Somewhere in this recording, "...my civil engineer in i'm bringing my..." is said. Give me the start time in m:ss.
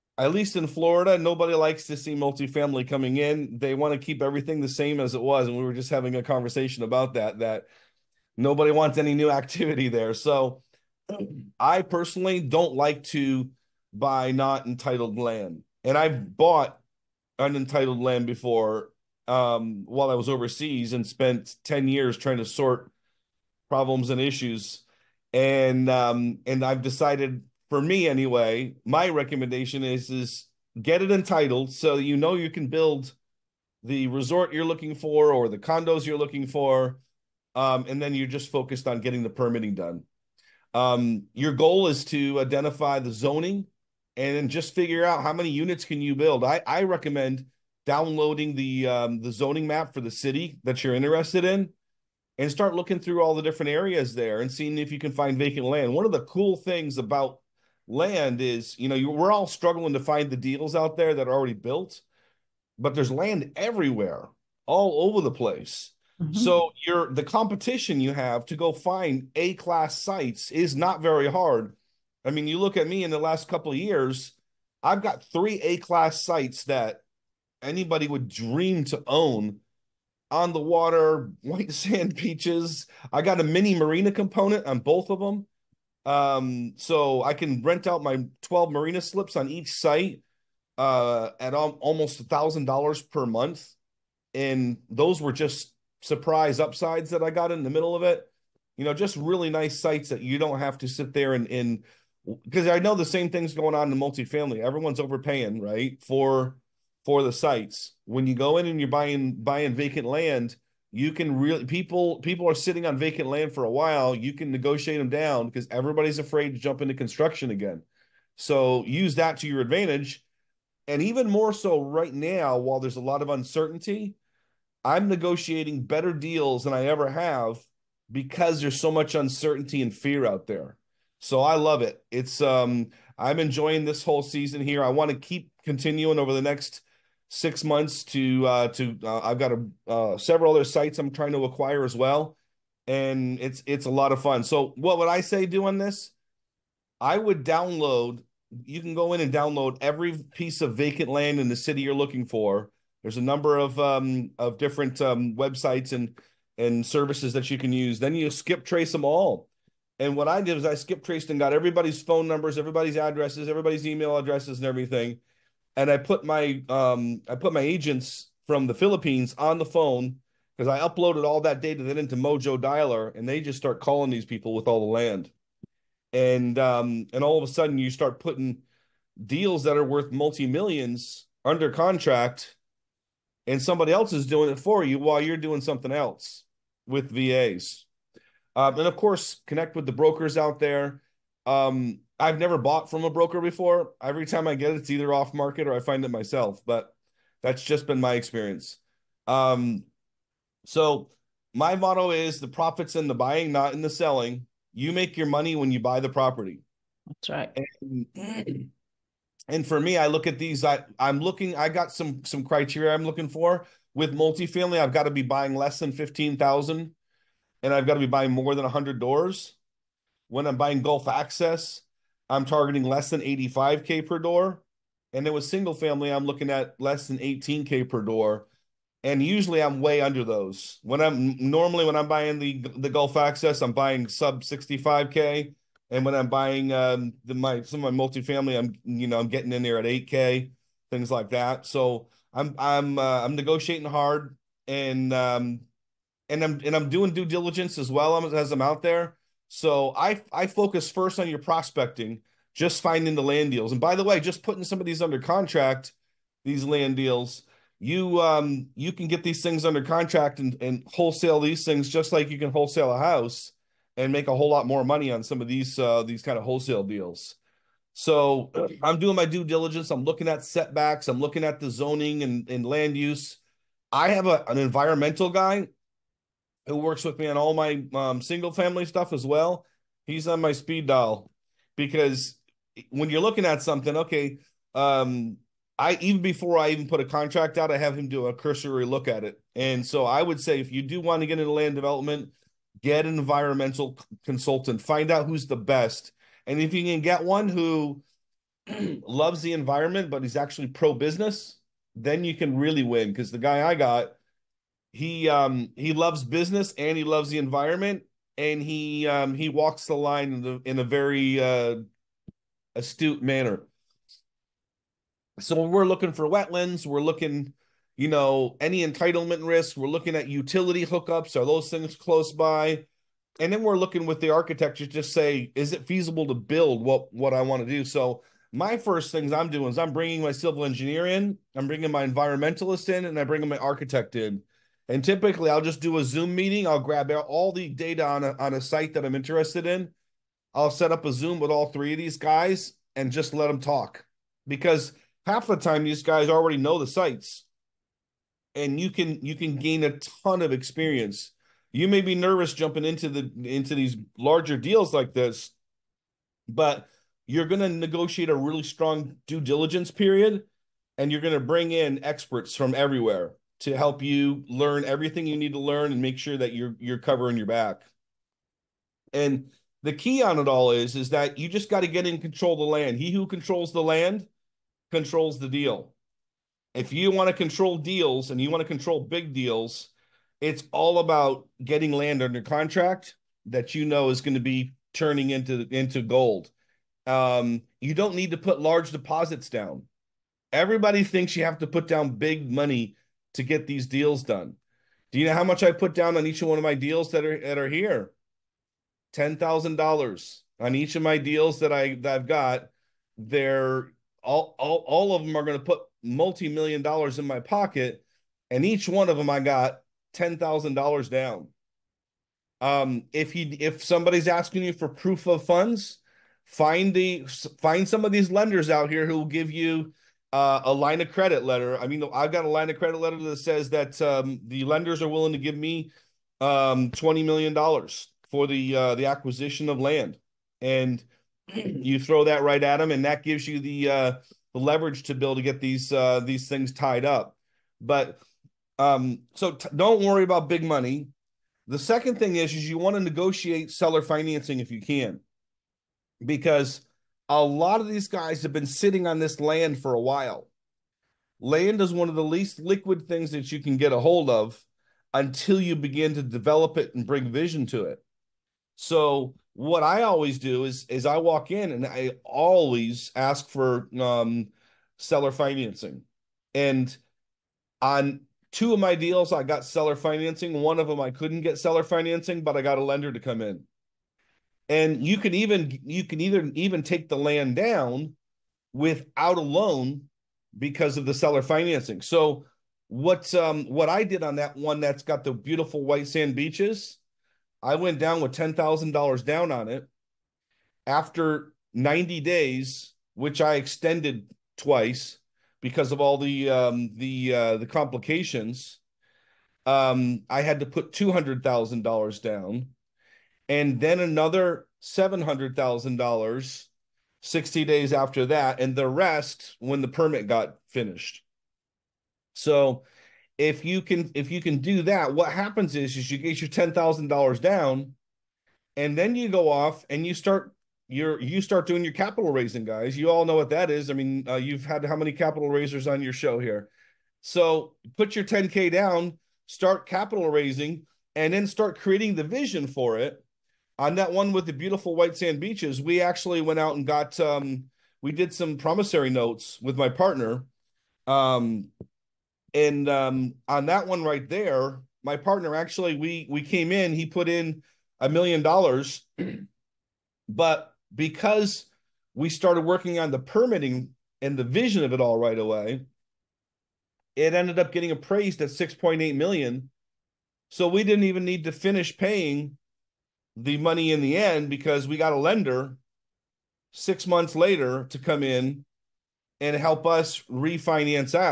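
5:30.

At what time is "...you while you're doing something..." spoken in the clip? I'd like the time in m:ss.
3:04.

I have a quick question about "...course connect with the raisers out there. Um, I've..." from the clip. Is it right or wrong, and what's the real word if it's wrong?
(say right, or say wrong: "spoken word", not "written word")
wrong: "brokers", not "raisers".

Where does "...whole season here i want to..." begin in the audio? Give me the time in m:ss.
2:14.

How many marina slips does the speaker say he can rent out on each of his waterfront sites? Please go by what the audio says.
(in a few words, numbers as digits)
12.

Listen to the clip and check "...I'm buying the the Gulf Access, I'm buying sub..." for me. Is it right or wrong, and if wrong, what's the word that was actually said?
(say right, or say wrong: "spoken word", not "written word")
right.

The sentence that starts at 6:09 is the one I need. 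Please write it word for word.
And the key on it all is is that you just got to get in control of the land.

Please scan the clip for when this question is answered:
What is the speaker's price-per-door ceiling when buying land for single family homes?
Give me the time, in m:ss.
3:47.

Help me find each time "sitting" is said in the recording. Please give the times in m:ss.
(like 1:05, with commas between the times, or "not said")
1:52, 7:28.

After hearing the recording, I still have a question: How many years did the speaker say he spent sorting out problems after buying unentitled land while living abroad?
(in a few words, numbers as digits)
10.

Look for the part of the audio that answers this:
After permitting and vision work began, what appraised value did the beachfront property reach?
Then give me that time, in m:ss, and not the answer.
9:18.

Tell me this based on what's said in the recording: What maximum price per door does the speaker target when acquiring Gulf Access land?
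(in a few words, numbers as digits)
85K.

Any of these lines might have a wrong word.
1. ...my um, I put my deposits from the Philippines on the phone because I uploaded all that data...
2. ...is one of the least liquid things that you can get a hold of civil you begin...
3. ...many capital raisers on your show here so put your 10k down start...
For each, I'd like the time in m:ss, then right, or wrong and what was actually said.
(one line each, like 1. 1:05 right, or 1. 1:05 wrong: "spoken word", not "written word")
1. 2:46 wrong: "agents", not "deposits"
2. 7:31 wrong: "until", not "civil"
3. 8:44 right.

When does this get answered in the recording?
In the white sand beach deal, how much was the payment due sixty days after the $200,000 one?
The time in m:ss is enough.
8:24.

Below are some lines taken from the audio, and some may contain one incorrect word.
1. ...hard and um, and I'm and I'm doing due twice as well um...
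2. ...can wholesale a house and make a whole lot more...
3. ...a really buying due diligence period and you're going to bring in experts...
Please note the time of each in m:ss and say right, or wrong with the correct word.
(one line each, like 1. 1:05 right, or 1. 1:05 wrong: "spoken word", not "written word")
1. 4:03 wrong: "diligence", not "twice"
2. 4:22 right
3. 5:58 wrong: "strong", not "buying".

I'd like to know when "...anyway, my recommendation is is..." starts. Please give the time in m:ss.
0:28.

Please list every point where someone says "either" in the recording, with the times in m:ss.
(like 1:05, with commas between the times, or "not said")
3:14, 7:56.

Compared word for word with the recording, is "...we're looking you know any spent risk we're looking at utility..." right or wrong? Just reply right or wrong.
wrong.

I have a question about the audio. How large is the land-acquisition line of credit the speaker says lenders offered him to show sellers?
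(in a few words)
$20 million.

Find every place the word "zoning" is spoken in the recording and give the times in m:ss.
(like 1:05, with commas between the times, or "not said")
0:43, 0:49, 4:31.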